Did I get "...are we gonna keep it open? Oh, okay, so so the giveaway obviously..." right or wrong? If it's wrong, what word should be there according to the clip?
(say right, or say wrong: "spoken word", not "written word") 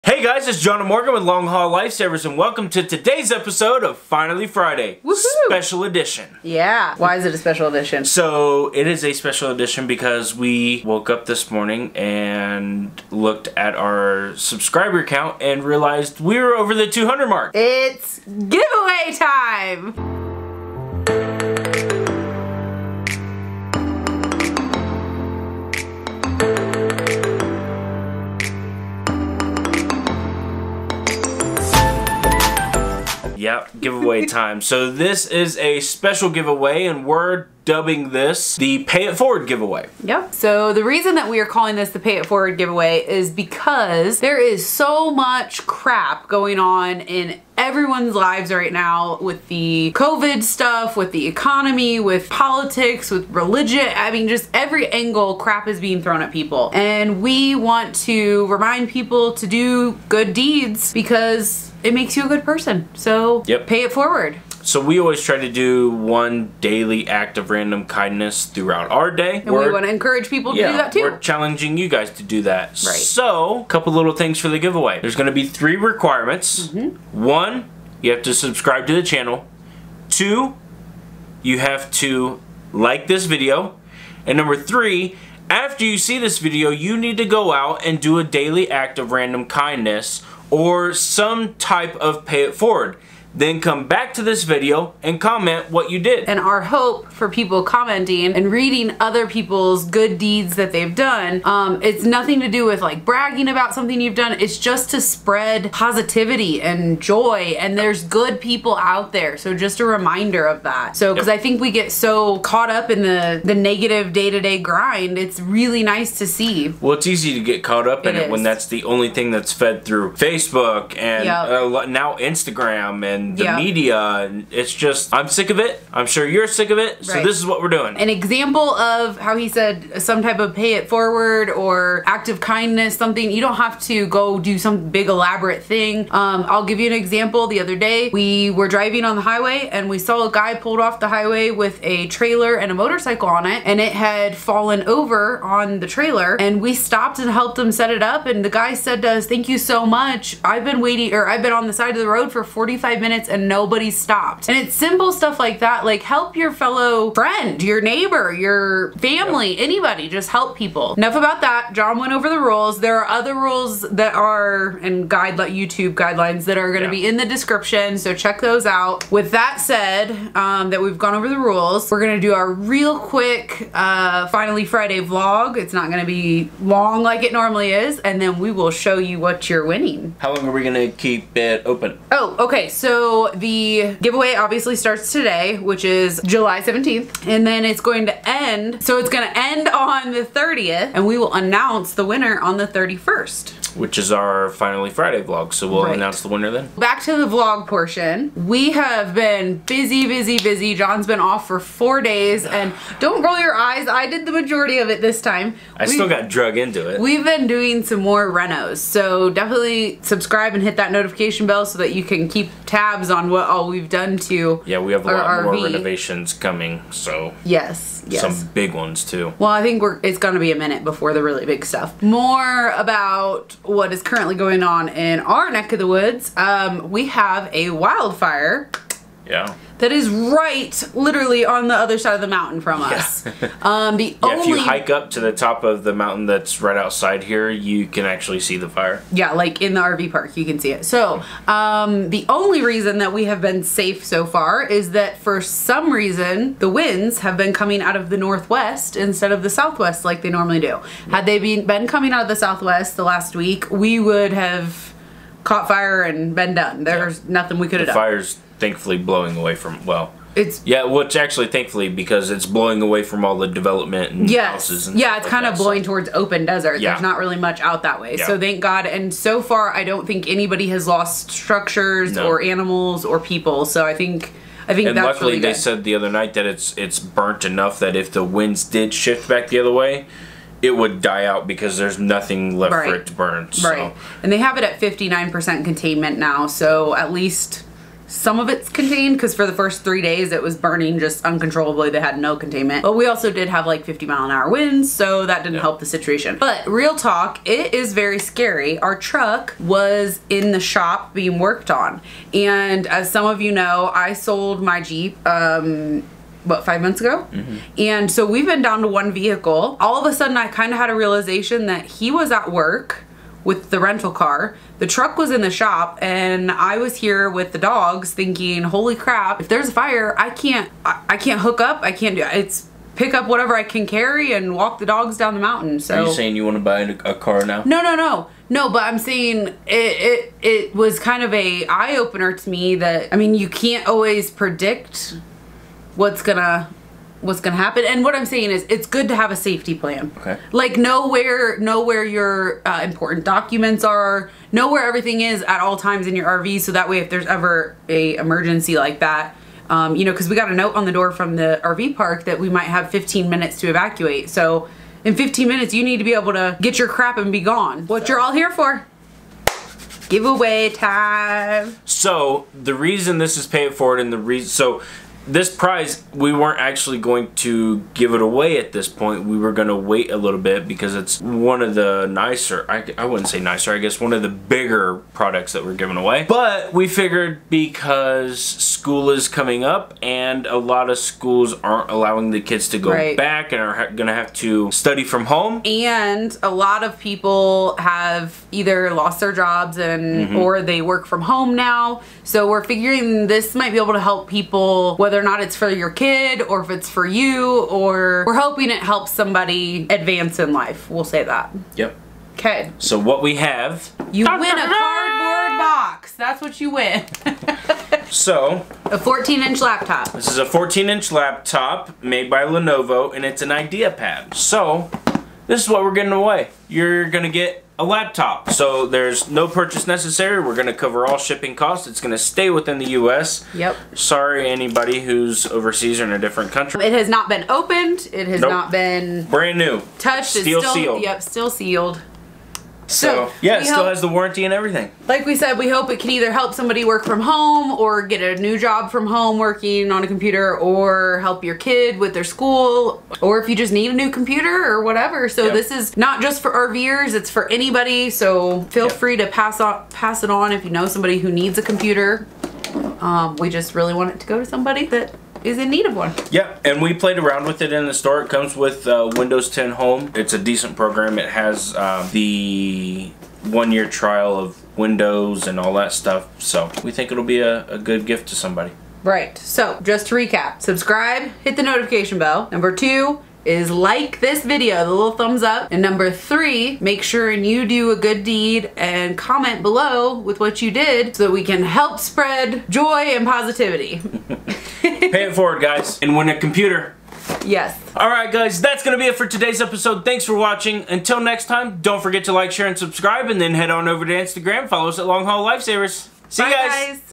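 right.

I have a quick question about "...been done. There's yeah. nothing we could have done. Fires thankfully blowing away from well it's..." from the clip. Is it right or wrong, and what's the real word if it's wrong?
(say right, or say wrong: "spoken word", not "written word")
right.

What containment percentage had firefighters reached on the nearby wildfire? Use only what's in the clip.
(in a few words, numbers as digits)
59%.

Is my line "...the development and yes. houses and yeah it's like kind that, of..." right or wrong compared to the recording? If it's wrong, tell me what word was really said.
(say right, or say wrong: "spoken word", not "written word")
right.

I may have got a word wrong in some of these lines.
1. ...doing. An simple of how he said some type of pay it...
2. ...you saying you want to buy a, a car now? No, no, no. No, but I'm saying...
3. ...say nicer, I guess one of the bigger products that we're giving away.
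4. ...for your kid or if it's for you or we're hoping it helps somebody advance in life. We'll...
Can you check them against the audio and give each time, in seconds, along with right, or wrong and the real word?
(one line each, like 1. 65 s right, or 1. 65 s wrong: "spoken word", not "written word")
1. 127 s wrong: "example", not "simple"
2. 326 s right
3. 373 s right
4. 395 s right.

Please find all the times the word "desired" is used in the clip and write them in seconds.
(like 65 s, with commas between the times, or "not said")
not said.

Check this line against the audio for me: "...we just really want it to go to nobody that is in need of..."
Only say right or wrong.
wrong.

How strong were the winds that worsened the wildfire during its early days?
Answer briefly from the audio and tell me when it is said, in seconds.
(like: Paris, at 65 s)
50 mile an hour, at 293 s.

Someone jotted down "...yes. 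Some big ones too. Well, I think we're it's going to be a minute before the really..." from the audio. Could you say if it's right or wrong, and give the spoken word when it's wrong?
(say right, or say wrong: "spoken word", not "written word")
right.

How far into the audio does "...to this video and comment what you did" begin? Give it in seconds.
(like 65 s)
94 s.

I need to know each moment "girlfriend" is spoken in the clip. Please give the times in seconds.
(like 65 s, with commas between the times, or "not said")
not said.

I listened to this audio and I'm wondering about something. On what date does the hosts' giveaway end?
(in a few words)
the 30th.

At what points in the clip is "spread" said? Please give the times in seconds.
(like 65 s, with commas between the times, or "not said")
105 s, 481 s.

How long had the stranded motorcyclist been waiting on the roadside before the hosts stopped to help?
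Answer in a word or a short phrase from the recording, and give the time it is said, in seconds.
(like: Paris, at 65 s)
45 minutes, at 152 s.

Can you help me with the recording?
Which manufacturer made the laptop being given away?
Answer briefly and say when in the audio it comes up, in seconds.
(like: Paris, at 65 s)
Lenovo, at 412 s.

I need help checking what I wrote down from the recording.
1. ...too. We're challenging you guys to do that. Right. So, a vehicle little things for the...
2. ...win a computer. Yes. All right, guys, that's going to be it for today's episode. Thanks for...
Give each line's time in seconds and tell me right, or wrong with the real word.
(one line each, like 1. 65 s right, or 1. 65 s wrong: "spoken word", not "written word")
1. 70 s wrong: "couple", not "vehicle"
2. 486 s right.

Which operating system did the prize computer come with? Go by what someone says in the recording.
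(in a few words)
Windows 10 Home.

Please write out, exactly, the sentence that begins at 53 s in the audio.
I mean, just every angle crap is being thrown at people.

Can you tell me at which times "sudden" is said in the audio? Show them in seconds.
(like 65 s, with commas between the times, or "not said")
310 s.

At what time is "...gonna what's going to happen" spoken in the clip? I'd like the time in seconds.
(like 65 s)
336 s.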